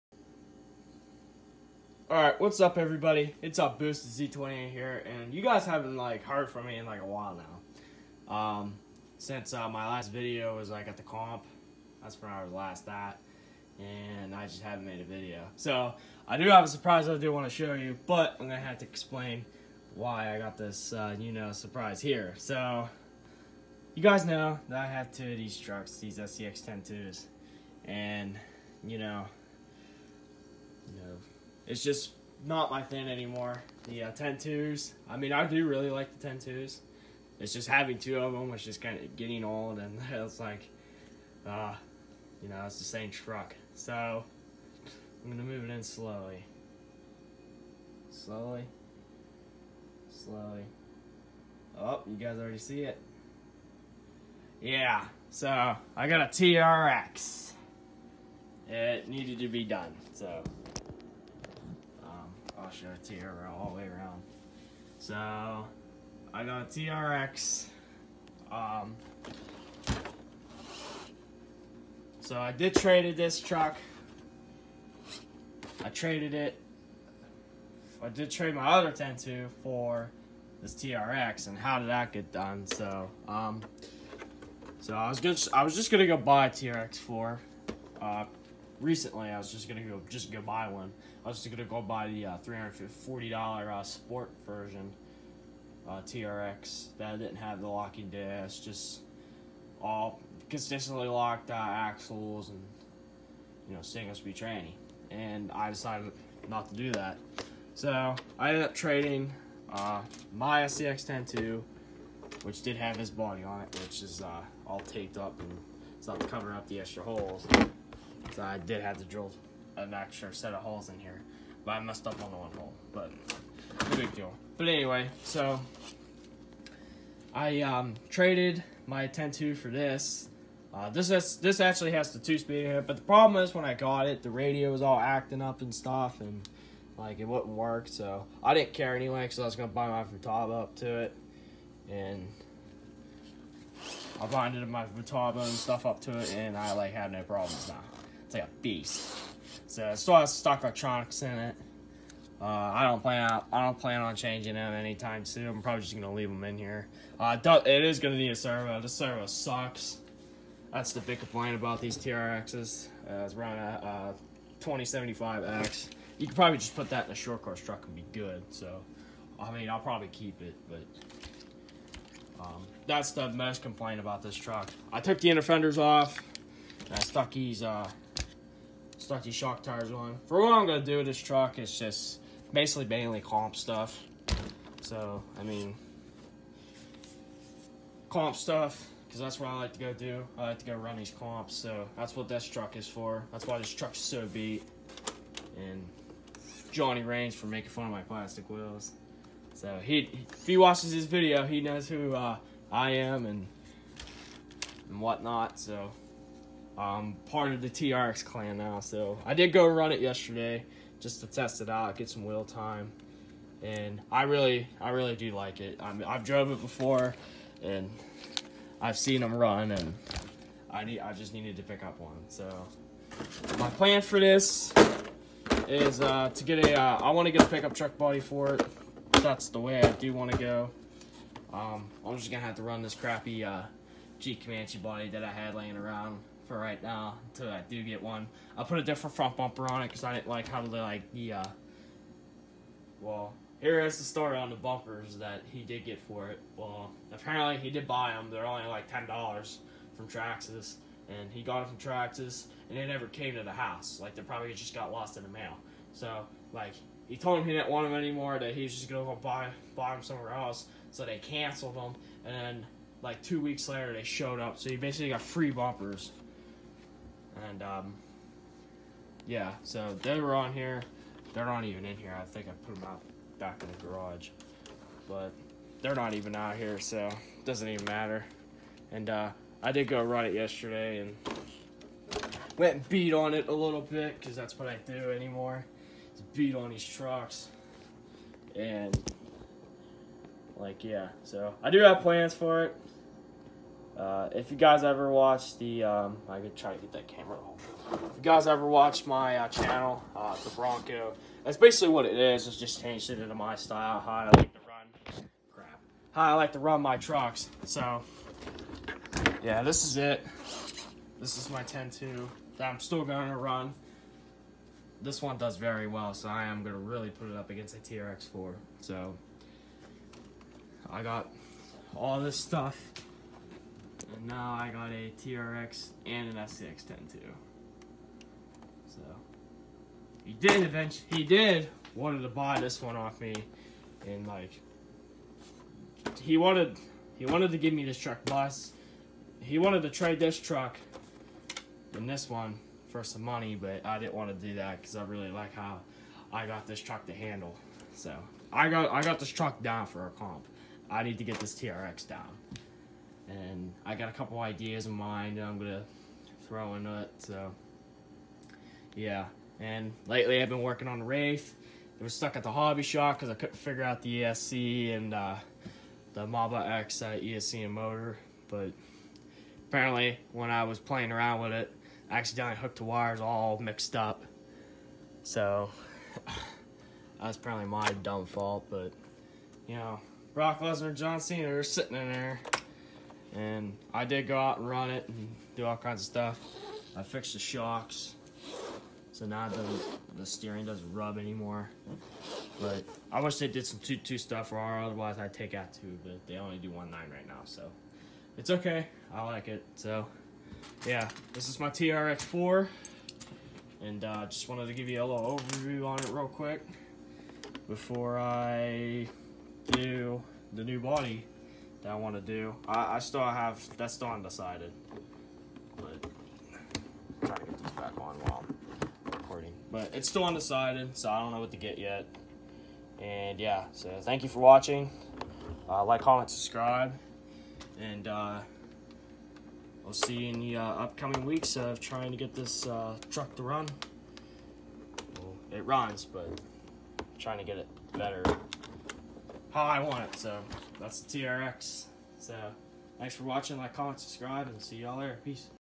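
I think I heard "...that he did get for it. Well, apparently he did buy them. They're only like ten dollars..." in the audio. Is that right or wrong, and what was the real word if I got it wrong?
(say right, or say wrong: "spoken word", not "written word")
right.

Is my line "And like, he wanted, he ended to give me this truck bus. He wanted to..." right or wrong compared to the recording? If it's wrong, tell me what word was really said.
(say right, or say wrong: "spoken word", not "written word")
wrong: "wanted", not "ended".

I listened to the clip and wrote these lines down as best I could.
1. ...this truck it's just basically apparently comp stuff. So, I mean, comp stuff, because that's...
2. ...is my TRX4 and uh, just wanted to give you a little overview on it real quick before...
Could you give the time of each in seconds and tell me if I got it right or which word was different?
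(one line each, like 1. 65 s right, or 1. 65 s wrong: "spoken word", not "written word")
1. 181 s wrong: "mainly", not "apparently"
2. 401 s right.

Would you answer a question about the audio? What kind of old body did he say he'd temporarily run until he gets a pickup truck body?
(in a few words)
Jeep Comanche.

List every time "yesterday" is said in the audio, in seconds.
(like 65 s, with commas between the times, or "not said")
210 s, 280 s.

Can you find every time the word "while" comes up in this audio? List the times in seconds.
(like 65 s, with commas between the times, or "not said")
7 s, 418 s.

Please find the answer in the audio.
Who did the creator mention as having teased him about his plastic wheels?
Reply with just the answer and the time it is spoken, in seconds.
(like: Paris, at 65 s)
Johnny Reigns, at 196 s.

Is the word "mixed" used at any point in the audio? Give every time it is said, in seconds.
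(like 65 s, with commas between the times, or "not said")
373 s.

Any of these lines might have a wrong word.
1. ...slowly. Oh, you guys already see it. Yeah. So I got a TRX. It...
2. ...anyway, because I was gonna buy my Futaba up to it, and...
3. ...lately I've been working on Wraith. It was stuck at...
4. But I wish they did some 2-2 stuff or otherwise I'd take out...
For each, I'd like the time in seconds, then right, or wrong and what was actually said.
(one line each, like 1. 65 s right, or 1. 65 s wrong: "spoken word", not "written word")
1. 50 s right
2. 138 s right
3. 360 s right
4. 392 s right.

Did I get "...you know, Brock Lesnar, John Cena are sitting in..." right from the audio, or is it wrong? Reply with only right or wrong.
right.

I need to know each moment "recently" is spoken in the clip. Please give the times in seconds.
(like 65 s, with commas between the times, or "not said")
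88 s.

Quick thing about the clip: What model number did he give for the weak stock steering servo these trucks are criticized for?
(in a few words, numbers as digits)
2075X.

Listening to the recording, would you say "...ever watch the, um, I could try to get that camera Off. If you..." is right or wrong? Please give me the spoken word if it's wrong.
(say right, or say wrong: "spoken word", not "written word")
right.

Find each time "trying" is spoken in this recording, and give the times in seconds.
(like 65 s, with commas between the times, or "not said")
417 s, 431 s, 437 s.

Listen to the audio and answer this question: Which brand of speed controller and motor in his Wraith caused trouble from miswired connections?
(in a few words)
Mamba X.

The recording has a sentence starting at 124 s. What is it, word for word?
But anyway, so I um, traded my 10-2 for this.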